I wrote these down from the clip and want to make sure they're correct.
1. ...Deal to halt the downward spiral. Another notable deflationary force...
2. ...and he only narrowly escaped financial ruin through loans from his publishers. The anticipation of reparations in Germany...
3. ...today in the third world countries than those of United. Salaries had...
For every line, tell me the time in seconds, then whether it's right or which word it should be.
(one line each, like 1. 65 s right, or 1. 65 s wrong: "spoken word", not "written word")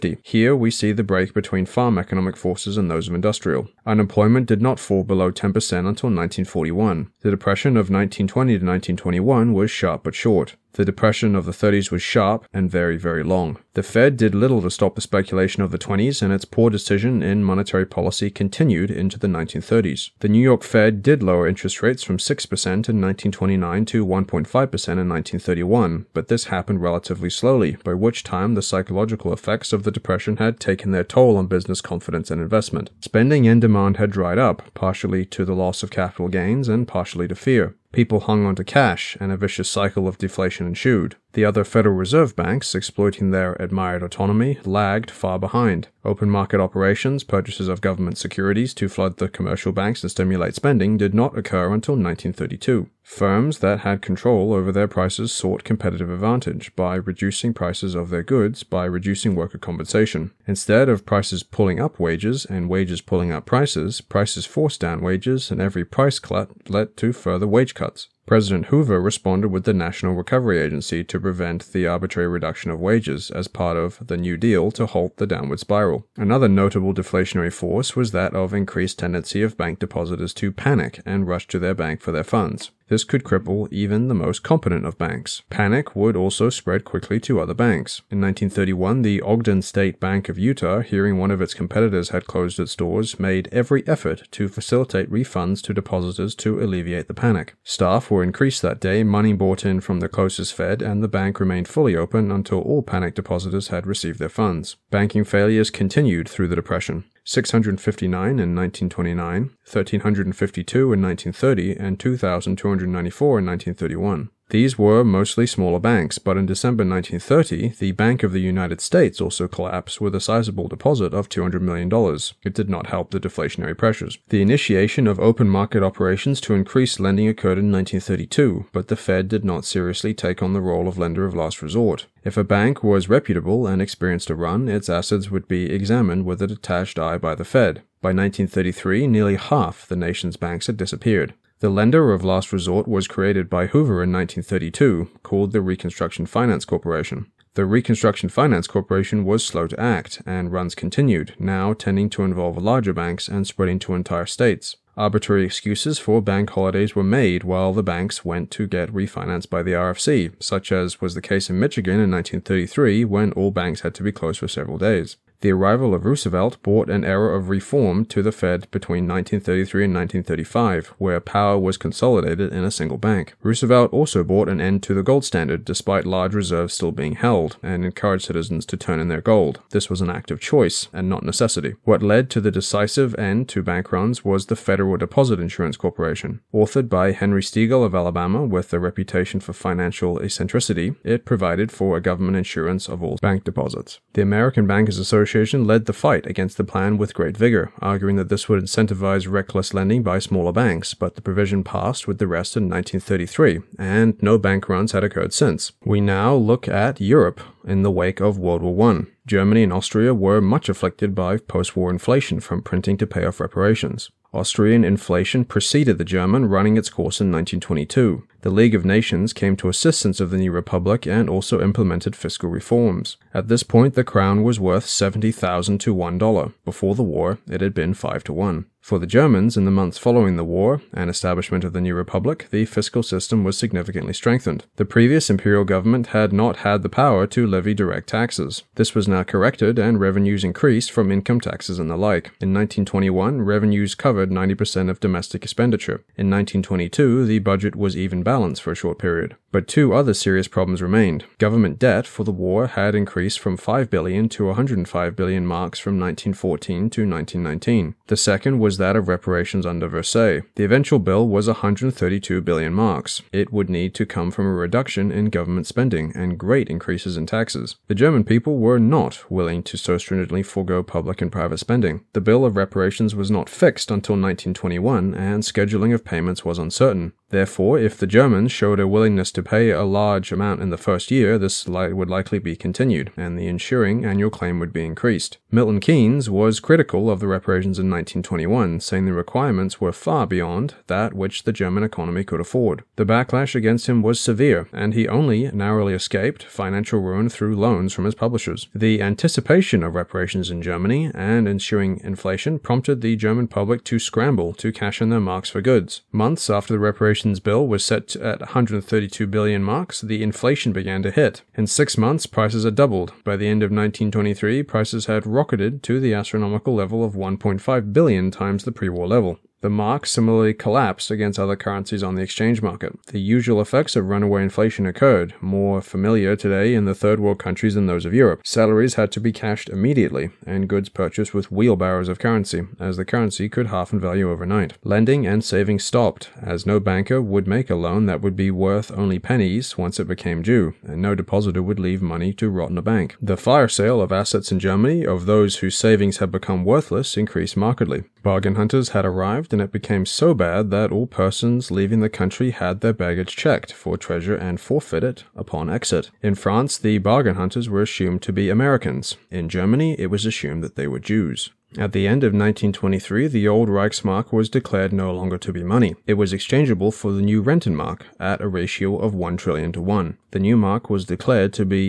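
1. 74 s right
2. 294 s right
3. 326 s wrong: "Europe", not "United".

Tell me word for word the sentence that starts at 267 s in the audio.
The German people were not willing to so stringently forego public and private spending.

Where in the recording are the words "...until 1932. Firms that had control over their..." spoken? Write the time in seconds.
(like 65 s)
51 s.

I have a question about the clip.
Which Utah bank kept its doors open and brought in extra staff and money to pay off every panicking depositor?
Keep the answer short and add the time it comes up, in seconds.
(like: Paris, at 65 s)
Ogden State Bank, at 89 s.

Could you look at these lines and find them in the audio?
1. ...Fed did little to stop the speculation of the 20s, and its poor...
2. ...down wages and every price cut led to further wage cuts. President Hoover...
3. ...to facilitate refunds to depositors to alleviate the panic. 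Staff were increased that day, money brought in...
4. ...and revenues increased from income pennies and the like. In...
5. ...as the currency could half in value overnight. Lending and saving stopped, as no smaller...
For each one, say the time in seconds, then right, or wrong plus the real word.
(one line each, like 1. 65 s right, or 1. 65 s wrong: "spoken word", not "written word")
1. 13 s right
2. 64 s right
3. 94 s right
4. 239 s wrong: "taxes", not "pennies"
5. 332 s wrong: "banker", not "smaller".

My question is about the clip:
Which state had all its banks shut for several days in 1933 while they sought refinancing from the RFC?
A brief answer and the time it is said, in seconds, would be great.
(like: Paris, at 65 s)
Michigan, at 161 s.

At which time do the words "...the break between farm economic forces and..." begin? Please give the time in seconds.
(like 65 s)
0 s.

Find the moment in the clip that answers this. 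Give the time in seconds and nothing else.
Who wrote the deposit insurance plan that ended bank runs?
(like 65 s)
187 s.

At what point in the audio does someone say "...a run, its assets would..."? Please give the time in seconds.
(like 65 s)
134 s.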